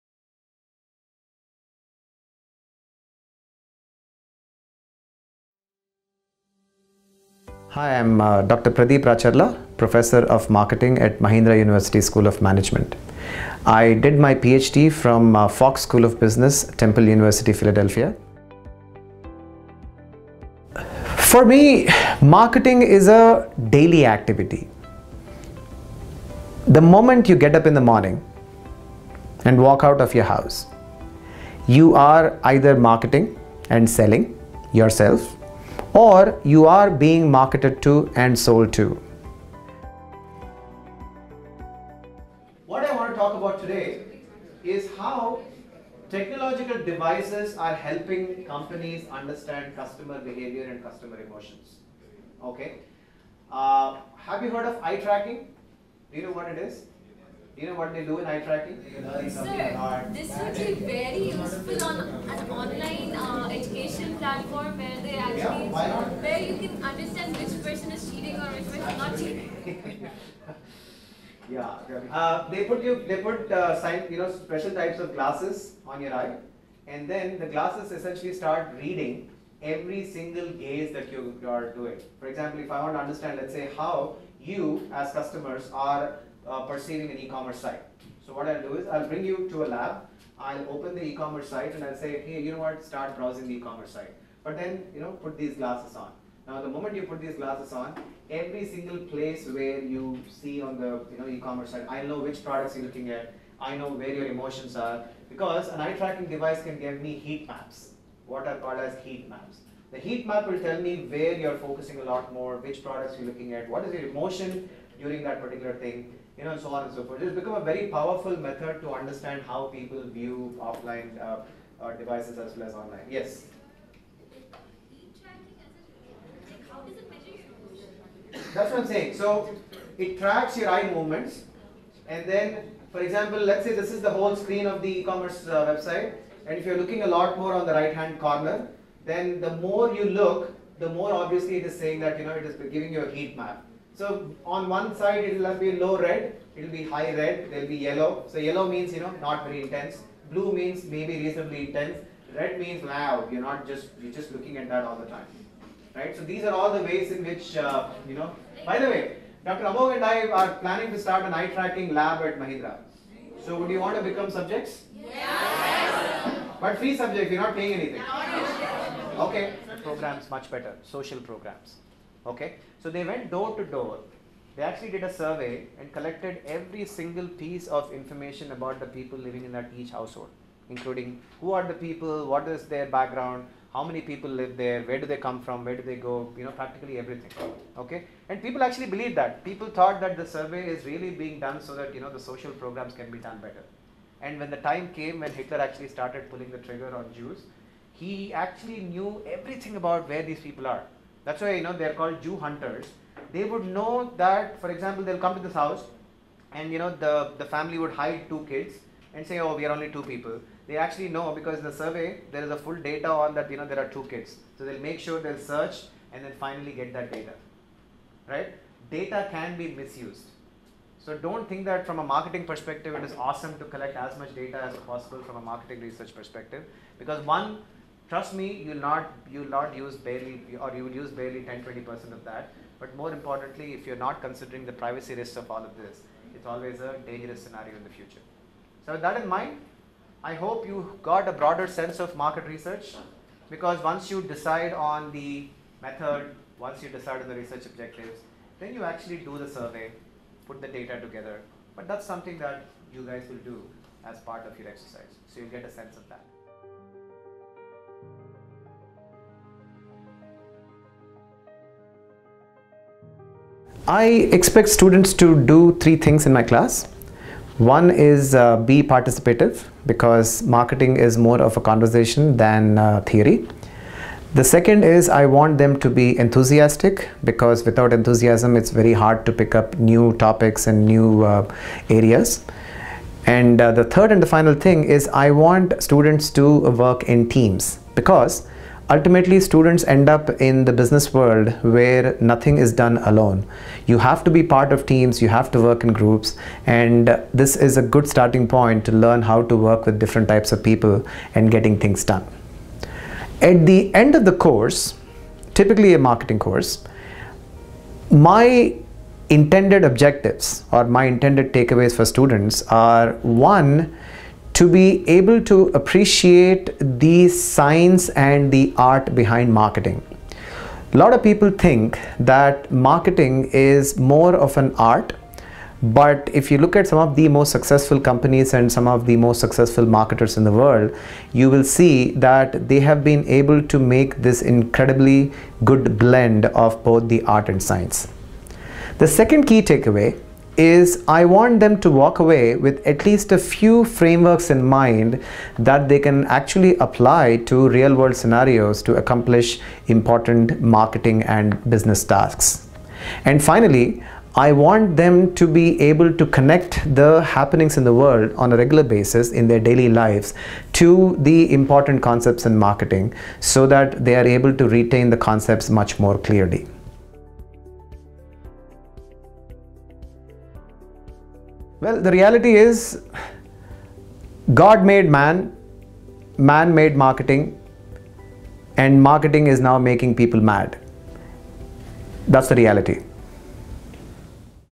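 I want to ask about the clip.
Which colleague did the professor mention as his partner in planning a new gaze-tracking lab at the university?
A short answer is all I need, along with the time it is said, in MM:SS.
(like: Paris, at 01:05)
Dr. Amog, at 02:39.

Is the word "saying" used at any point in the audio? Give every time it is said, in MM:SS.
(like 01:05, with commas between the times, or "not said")
02:08, 02:21.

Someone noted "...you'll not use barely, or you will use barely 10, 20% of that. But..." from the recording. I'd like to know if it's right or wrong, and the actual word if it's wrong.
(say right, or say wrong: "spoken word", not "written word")
right.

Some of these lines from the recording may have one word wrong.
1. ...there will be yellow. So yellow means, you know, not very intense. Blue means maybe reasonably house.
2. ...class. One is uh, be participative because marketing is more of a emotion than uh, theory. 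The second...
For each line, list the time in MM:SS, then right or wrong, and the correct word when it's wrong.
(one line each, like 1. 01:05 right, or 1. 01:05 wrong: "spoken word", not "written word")
1. 02:27 wrong: "intense", not "house"
2. 04:26 wrong: "conversation", not "emotion".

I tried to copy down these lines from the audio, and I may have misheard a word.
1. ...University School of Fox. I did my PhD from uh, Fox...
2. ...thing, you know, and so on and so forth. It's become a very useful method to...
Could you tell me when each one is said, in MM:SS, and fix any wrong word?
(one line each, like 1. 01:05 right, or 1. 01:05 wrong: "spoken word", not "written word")
1. 00:11 wrong: "Management", not "Fox"
2. 01:55 wrong: "powerful", not "useful".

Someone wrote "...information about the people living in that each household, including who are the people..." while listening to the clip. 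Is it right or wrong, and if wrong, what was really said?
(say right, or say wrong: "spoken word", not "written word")
right.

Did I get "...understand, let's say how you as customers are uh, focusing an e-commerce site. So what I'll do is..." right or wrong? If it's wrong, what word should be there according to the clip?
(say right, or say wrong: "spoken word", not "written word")
wrong: "perceiving", not "focusing".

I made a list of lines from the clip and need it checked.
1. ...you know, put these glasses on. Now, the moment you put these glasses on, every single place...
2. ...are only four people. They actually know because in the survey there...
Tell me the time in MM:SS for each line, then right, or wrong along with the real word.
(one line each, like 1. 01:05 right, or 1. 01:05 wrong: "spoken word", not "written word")
1. 01:34 right
2. 03:29 wrong: "two", not "four".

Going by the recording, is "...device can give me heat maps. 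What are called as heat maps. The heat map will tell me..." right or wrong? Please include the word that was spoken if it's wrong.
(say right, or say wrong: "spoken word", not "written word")
right.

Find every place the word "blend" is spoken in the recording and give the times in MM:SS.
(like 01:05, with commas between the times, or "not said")
05:35.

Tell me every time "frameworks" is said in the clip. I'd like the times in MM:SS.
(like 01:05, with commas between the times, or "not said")
05:43.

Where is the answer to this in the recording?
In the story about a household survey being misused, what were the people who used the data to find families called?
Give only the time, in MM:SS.
03:22.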